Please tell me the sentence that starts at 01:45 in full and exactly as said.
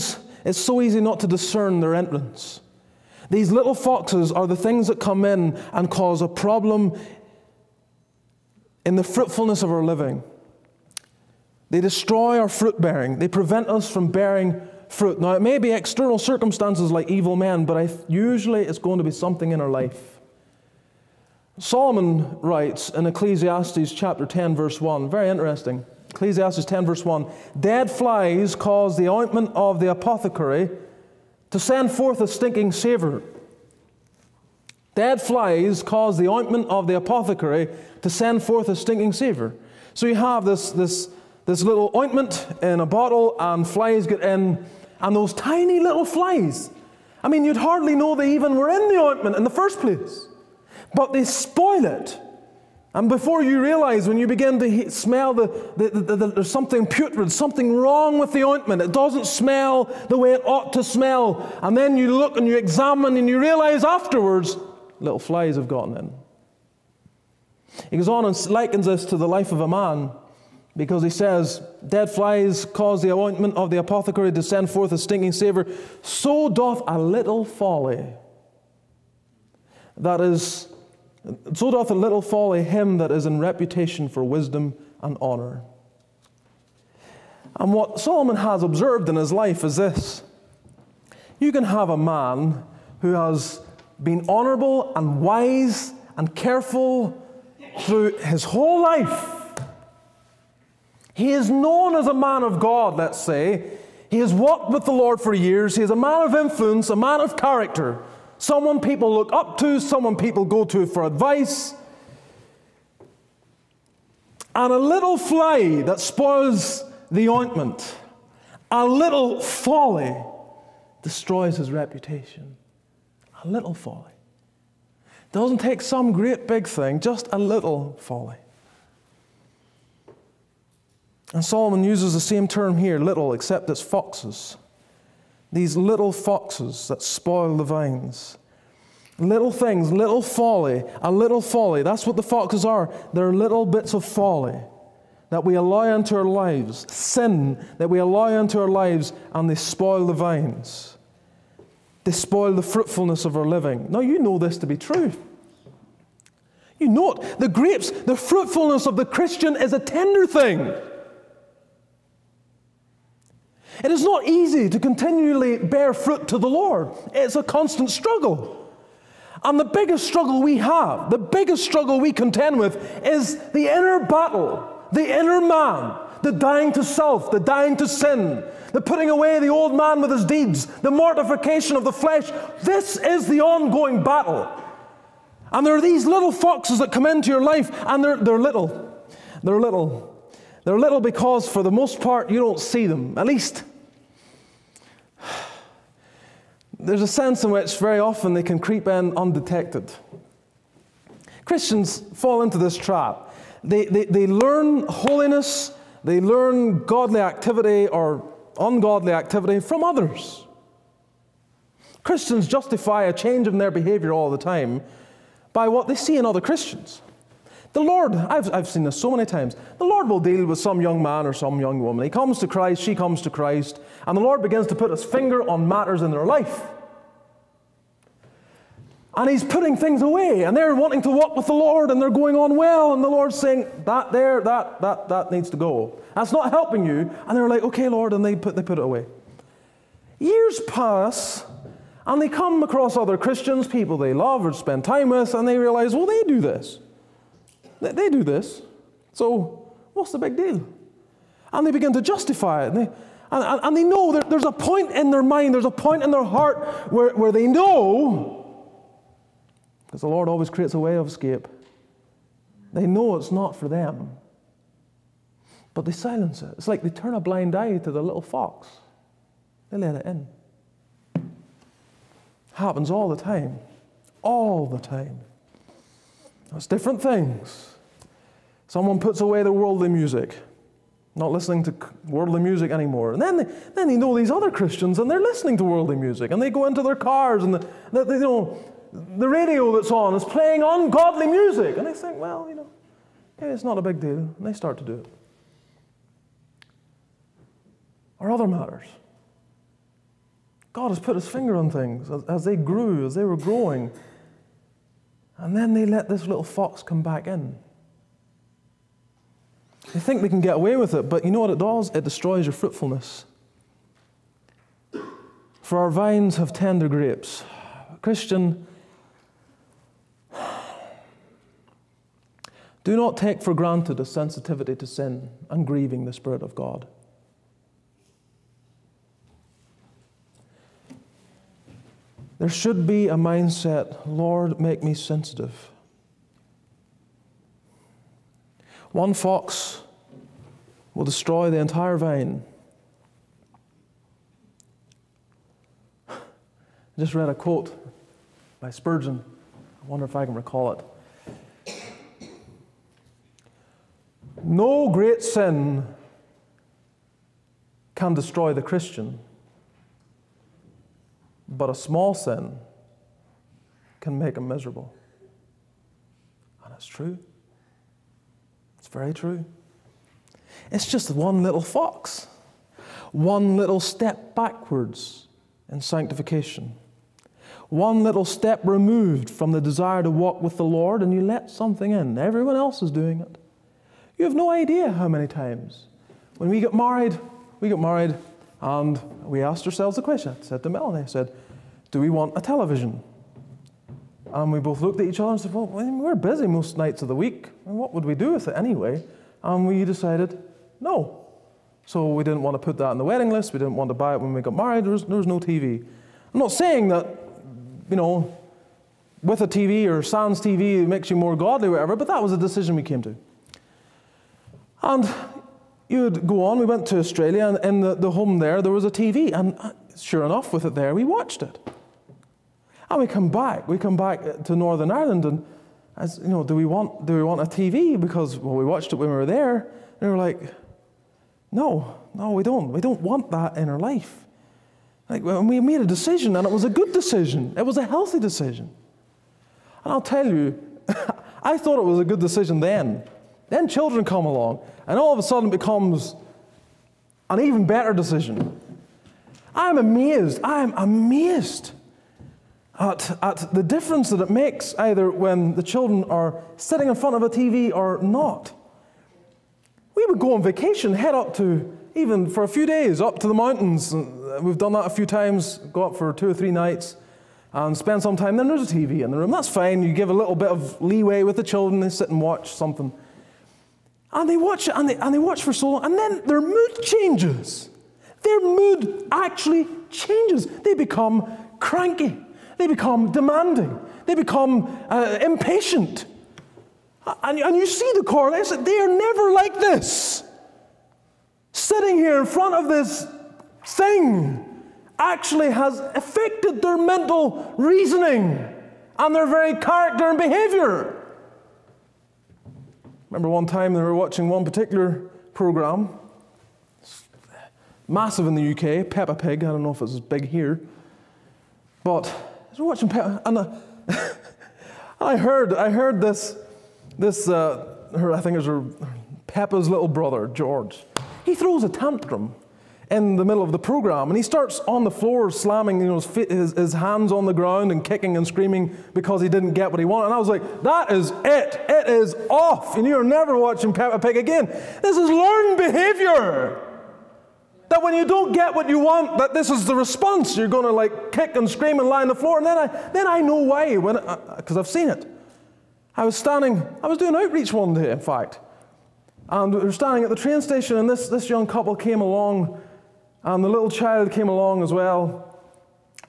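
He is a man of influence, a man of character, someone people look up to, someone people go to for advice.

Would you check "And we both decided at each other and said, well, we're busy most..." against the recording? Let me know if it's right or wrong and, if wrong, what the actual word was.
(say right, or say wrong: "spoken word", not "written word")
wrong: "looked", not "decided".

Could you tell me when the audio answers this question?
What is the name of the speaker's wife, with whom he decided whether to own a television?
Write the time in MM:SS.
06:30.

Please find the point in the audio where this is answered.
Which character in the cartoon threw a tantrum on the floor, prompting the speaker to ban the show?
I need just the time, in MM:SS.
08:40.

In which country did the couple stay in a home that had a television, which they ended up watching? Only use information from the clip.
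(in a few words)
Australia.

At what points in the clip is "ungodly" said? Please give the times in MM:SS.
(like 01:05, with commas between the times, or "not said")
03:28, 04:50.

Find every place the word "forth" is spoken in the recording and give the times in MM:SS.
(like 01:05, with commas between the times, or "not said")
00:31, 00:38, 01:14.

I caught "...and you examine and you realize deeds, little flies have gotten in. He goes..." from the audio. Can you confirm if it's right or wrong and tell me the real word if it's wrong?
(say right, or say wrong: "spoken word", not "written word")
wrong: "afterwards", not "deeds".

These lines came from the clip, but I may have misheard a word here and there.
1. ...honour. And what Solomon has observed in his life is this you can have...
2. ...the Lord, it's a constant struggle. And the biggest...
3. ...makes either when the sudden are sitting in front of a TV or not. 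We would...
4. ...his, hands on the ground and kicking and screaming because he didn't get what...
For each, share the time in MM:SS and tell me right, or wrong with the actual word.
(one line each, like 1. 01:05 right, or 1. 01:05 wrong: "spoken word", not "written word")
1. 01:25 right
2. 02:46 right
3. 07:34 wrong: "children", not "sudden"
4. 08:46 right.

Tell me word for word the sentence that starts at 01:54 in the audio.
And a little fly that spoils the ointment, a little folly destroys his reputation.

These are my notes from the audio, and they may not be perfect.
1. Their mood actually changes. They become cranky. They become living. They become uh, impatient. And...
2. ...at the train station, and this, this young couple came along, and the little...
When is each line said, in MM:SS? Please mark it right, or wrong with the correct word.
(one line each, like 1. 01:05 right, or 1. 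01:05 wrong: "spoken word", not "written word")
1. 07:58 wrong: "demanding", not "living"
2. 09:10 right.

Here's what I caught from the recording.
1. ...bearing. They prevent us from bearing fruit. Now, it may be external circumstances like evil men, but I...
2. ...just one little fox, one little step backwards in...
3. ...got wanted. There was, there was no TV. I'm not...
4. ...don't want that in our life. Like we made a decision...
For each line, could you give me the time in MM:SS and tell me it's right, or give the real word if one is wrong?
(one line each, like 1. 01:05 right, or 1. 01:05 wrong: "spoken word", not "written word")
1. 00:12 right
2. 06:10 right
3. 06:44 wrong: "married", not "wanted"
4. 07:12 right.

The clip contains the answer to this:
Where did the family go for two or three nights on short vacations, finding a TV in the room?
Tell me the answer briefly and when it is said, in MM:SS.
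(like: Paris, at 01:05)
the mountains, at 07:43.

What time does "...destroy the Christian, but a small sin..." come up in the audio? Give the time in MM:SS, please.
05:58.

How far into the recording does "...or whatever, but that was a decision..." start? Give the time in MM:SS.
06:51.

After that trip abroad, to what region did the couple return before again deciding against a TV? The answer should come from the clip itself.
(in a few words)
Northern Ireland.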